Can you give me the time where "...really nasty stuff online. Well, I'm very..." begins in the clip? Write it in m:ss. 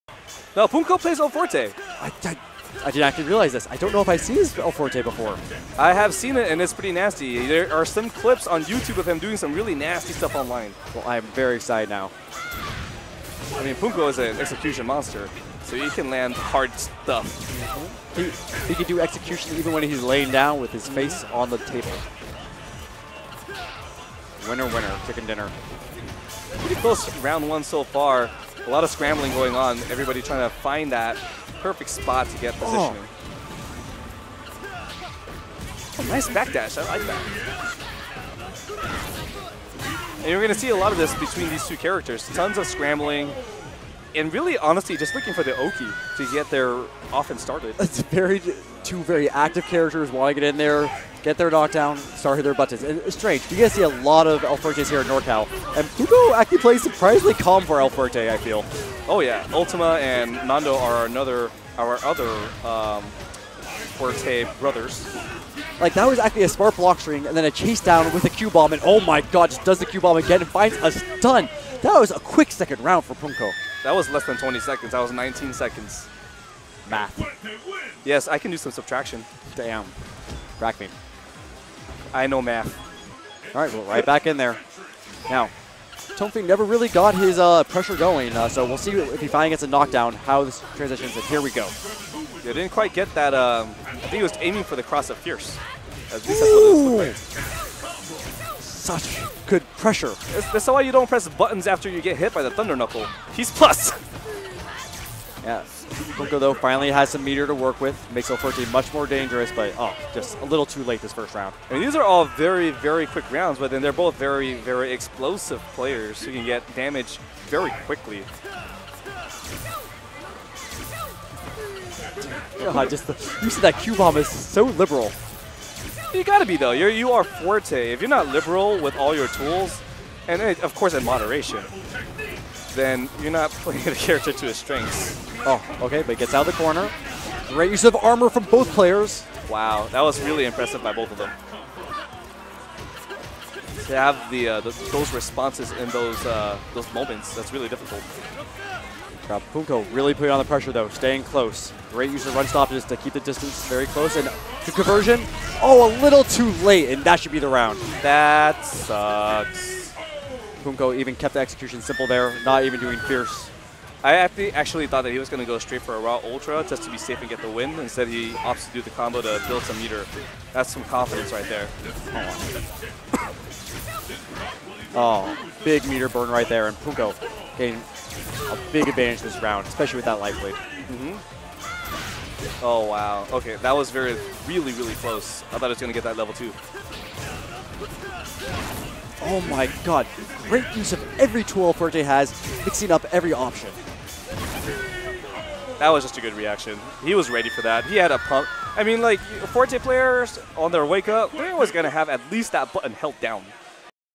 0:09.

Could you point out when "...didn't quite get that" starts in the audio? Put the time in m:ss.
1:32.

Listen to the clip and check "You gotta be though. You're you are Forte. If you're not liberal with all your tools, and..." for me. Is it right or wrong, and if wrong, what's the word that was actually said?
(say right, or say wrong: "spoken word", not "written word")
right.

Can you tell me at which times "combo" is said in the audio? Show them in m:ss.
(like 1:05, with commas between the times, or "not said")
2:48.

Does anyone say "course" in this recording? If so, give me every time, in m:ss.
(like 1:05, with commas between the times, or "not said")
2:10.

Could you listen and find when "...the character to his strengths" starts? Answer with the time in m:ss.
2:13.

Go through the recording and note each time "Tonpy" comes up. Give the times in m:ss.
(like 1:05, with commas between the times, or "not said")
1:26.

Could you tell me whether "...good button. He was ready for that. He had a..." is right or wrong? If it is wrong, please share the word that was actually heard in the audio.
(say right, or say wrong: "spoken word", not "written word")
wrong: "reaction", not "button".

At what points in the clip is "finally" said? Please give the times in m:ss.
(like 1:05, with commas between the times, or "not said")
1:29, 1:46.